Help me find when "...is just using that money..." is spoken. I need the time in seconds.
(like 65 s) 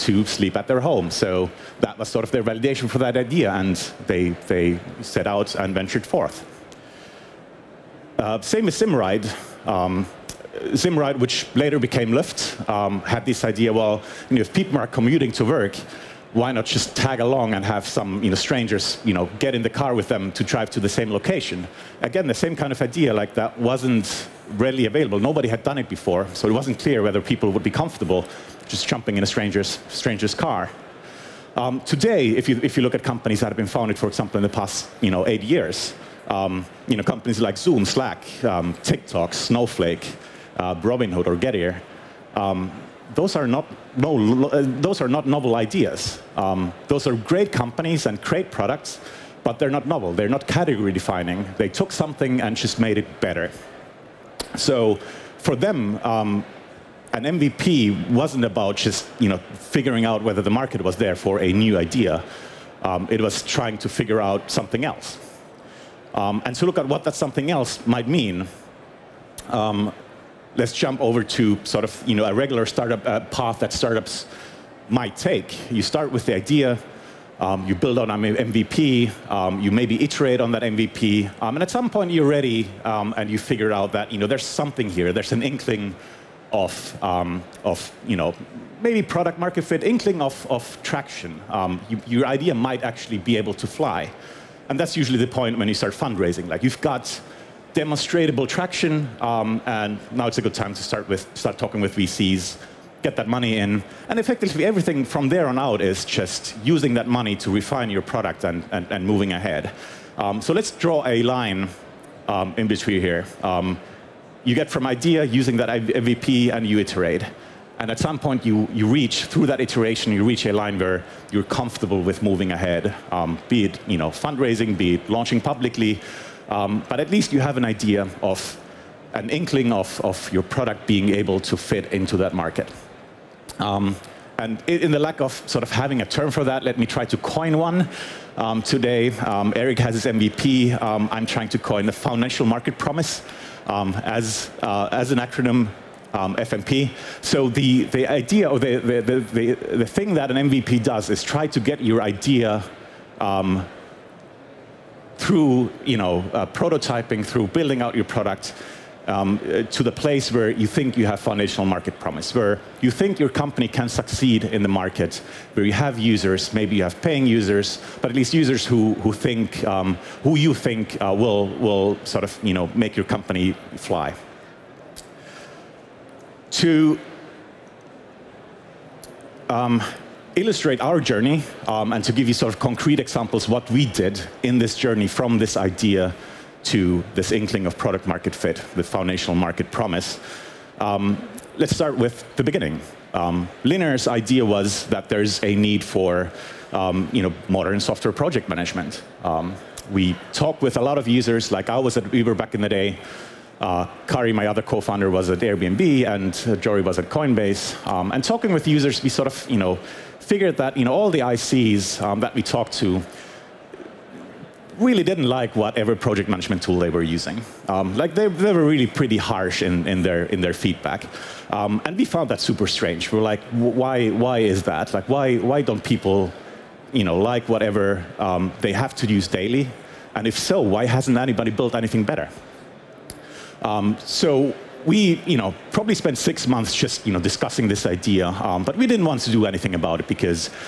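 105 s.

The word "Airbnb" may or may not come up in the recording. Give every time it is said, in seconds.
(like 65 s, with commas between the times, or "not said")
205 s.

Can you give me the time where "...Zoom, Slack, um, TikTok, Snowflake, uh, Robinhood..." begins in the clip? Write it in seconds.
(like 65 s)
37 s.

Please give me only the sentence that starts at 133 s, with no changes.
Um, and in the lack of sort of having a term for that, let me try to coin one.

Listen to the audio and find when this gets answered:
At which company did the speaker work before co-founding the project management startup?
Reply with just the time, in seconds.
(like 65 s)
202 s.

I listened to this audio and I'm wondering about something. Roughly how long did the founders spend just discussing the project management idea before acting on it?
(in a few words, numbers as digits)
6 months.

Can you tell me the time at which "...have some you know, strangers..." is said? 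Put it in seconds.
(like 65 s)
17 s.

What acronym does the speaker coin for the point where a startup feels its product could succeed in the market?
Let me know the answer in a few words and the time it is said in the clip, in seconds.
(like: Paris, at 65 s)
FMP, at 146 s.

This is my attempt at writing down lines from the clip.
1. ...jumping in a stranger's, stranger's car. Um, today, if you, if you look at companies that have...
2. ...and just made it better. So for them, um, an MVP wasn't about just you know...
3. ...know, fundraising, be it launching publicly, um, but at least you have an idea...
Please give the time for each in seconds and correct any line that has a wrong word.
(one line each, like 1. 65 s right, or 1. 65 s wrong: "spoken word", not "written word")
1. 28 s right
2. 52 s right
3. 124 s right.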